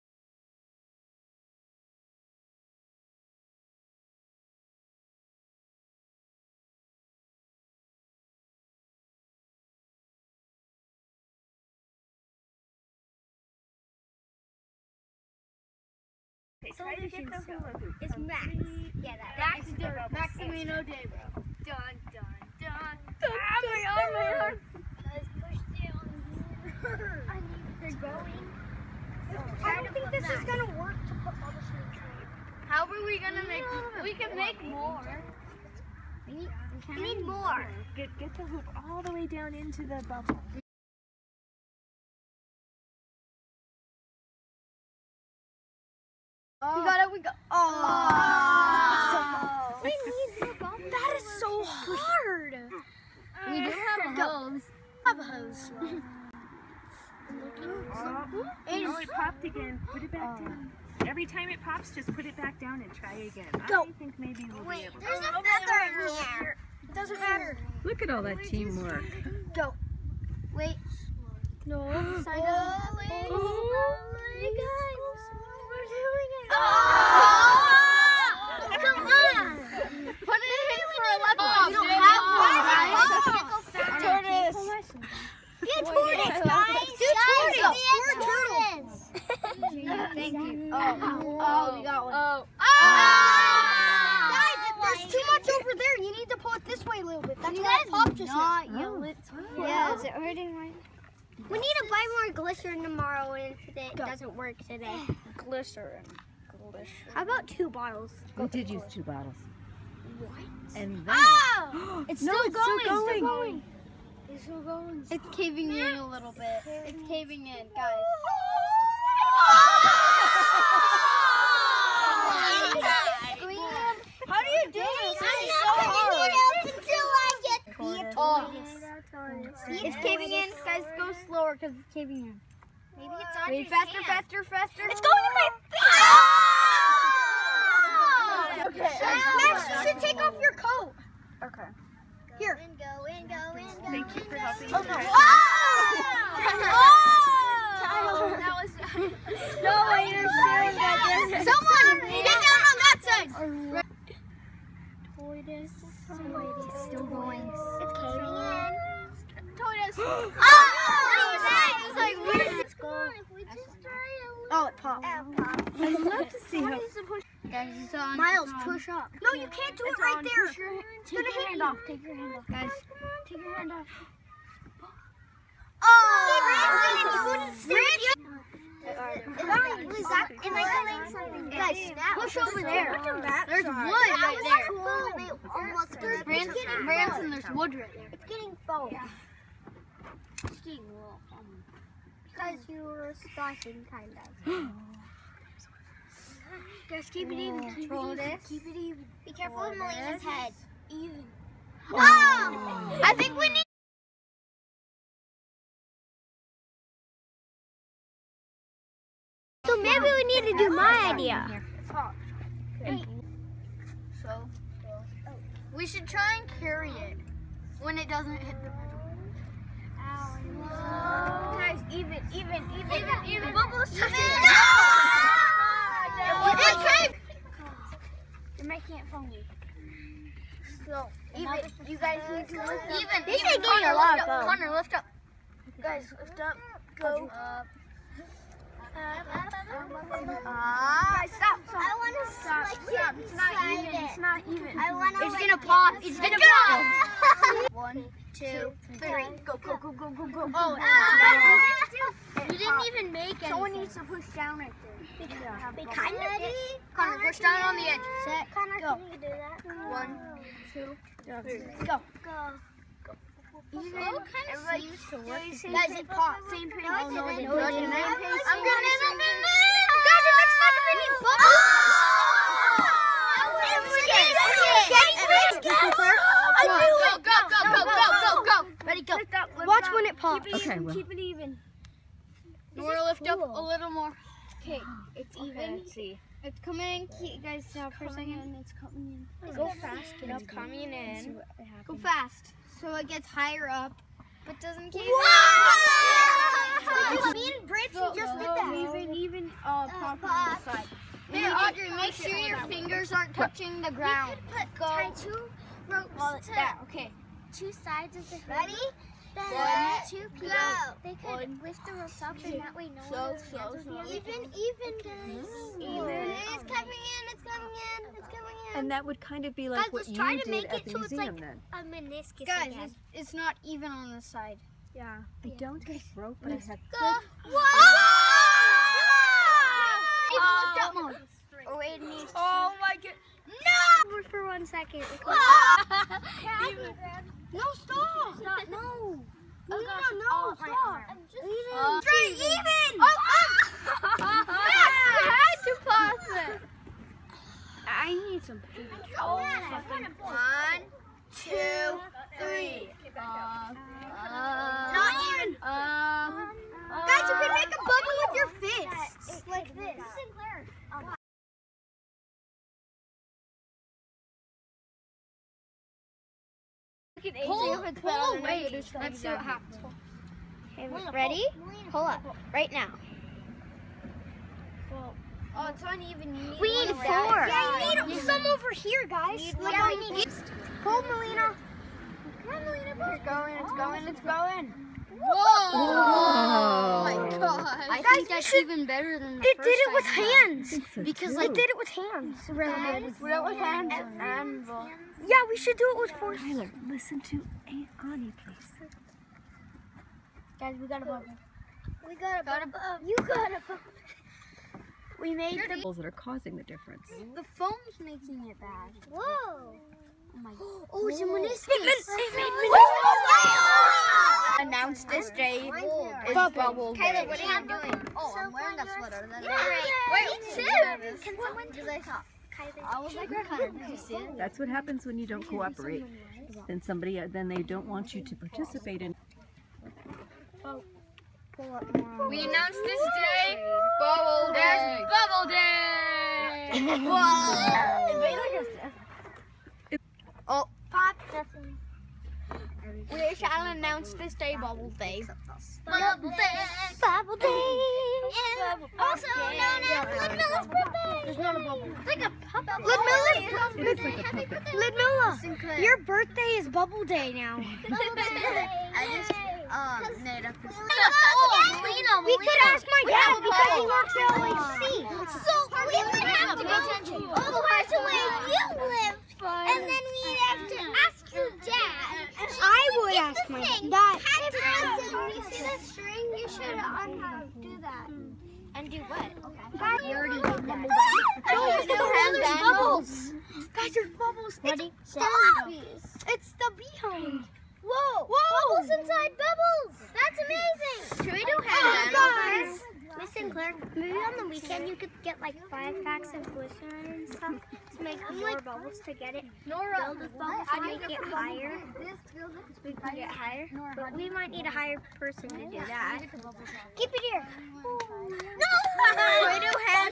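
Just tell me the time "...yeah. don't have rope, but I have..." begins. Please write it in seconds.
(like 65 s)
325 s.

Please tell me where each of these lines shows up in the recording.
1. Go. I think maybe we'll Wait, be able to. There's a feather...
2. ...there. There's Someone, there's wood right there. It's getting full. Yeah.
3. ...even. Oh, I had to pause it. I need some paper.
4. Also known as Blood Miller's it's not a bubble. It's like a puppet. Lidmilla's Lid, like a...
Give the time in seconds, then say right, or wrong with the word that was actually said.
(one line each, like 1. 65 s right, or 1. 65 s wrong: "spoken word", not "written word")
1. 63 s right
2. 185 s wrong: "Branson", not "Someone"
3. 342 s right
4. 448 s right.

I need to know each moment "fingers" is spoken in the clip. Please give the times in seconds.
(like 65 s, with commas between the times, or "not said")
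302 s.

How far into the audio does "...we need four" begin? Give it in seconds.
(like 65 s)
376 s.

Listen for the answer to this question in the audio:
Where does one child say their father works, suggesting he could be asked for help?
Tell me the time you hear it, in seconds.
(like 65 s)
464 s.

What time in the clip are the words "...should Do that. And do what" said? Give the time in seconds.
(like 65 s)
476 s.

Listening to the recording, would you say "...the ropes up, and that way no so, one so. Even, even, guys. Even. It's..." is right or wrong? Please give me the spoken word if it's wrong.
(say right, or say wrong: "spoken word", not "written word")
right.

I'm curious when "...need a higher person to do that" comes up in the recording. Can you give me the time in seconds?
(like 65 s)
504 s.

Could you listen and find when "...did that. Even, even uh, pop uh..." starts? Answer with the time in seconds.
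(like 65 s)
298 s.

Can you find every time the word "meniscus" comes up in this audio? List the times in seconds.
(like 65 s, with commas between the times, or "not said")
322 s, 411 s.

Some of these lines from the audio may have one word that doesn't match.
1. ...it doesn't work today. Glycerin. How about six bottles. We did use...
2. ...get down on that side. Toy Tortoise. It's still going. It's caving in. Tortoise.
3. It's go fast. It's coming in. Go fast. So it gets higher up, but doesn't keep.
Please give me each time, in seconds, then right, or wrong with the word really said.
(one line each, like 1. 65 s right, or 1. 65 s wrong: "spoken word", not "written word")
1. 103 s wrong: "two", not "six"
2. 152 s right
3. 289 s right.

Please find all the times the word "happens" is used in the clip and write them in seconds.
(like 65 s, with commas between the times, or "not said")
369 s, 424 s.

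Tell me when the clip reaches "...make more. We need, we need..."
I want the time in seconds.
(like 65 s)
34 s.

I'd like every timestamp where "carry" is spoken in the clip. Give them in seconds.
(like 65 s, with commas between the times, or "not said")
216 s.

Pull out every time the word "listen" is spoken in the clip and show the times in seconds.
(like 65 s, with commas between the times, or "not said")
396 s.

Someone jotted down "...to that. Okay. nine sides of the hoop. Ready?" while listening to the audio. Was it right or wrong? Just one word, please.
wrong.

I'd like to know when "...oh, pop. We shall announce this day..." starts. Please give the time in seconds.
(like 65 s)
440 s.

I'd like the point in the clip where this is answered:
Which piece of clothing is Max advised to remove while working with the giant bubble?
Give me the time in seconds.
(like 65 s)
140 s.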